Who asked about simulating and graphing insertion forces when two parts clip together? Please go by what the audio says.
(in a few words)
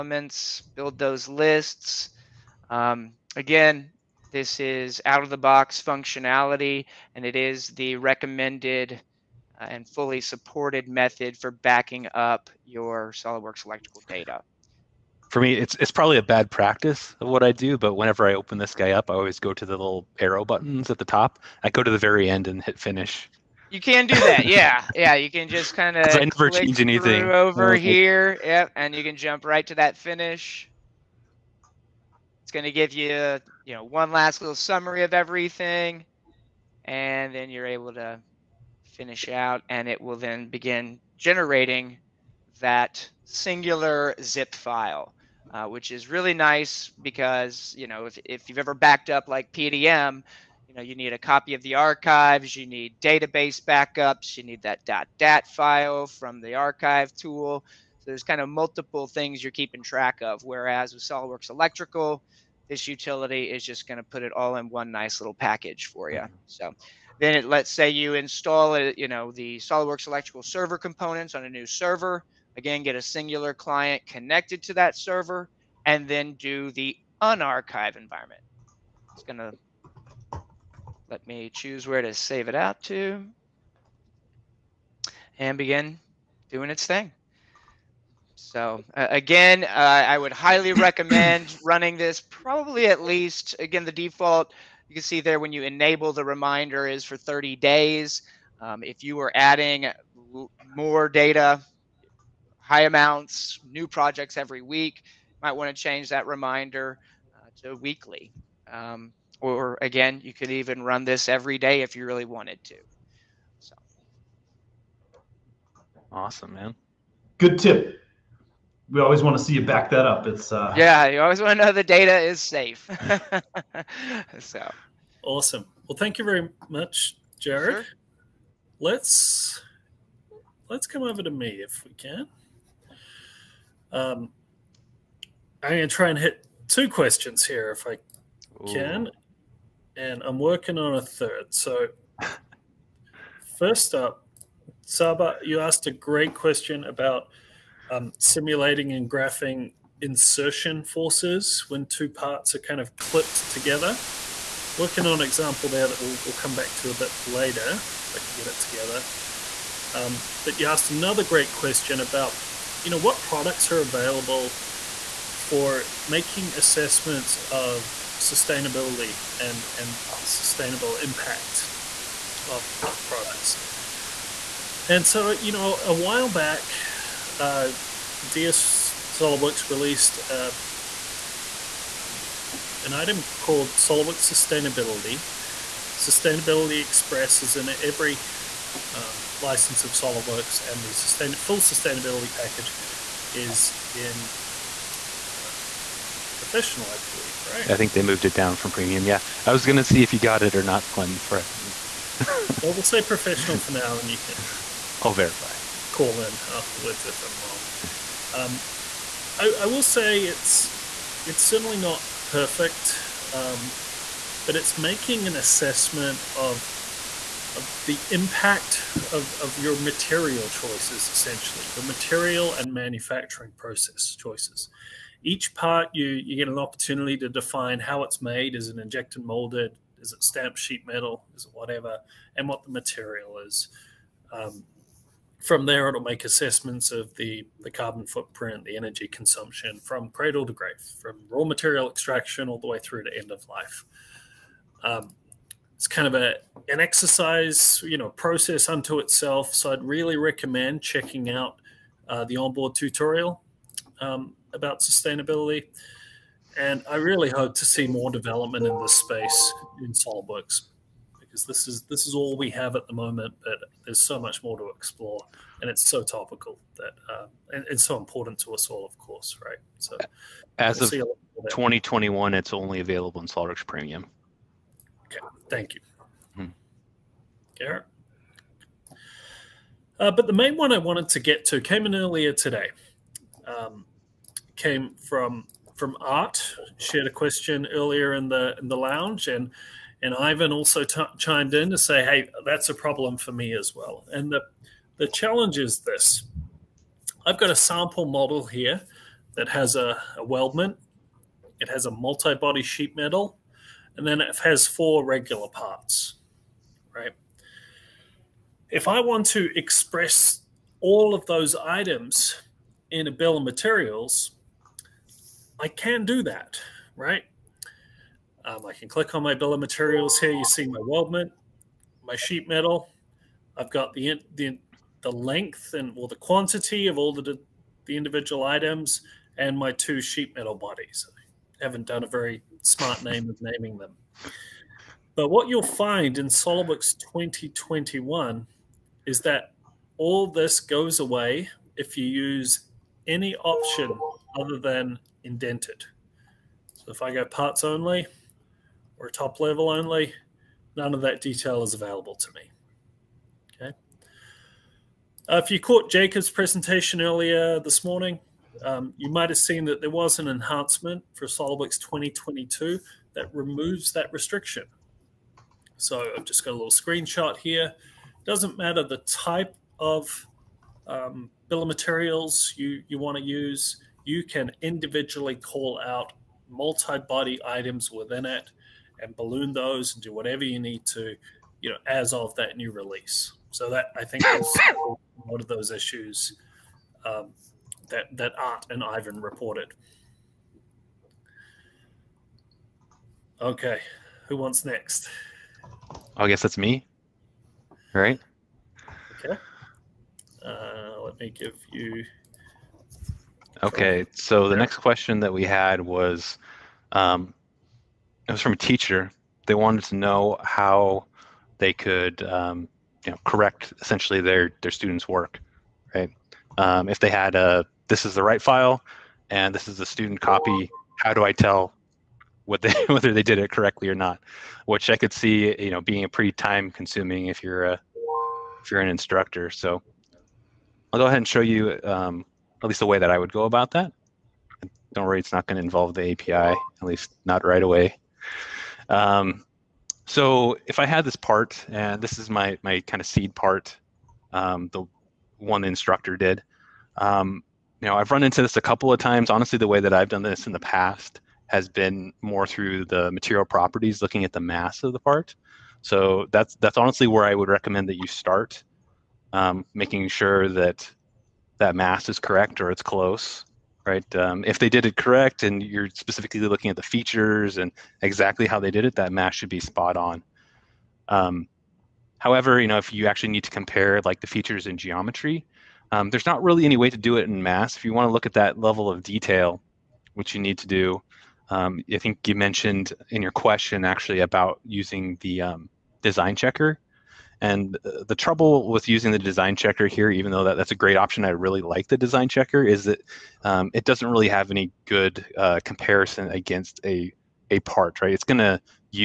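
Saba.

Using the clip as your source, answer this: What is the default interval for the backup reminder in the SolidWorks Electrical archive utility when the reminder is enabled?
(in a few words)
30 days.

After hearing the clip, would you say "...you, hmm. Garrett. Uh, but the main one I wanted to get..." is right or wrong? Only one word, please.
right.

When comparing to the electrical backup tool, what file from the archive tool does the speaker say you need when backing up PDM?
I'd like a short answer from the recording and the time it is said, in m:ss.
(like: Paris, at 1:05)
dot dat file, at 0:54.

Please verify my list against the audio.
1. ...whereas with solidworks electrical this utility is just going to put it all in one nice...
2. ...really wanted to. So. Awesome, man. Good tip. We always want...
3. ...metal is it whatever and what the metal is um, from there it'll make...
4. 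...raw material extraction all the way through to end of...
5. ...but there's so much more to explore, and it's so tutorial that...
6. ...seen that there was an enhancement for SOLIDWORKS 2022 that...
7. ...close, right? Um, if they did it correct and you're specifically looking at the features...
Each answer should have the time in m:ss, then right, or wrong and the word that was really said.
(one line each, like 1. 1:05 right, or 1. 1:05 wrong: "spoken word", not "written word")
1. 1:00 right
2. 1:52 right
3. 3:50 wrong: "material", not "metal"
4. 4:01 right
5. 4:23 wrong: "topical", not "tutorial"
6. 5:59 right
7. 7:42 right.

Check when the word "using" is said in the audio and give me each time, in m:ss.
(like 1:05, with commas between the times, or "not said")
8:04, 8:08.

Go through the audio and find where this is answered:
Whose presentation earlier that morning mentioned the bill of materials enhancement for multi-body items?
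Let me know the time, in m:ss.
5:55.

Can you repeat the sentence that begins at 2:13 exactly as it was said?
Um, I'm going to try and hit two questions here if I can.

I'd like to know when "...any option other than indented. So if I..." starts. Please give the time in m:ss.
5:43.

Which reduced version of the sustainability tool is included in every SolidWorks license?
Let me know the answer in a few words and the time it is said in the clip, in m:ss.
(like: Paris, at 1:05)
Sustainability Express, at 3:05.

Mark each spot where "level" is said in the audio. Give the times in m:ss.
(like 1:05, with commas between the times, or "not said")
5:49, 7:58.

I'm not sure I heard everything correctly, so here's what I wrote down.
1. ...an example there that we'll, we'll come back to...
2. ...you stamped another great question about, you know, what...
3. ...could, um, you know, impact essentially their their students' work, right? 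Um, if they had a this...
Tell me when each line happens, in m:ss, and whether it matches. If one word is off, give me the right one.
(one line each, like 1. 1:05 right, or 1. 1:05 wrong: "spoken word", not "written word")
1. 2:35 right
2. 2:40 wrong: "asked", not "stamped"
3. 6:51 wrong: "correct", not "impact".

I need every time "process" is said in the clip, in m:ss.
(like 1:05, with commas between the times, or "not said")
3:43, 4:08.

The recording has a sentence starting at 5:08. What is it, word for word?
If I want to express all of those items in a bill of materials, I can do that, right?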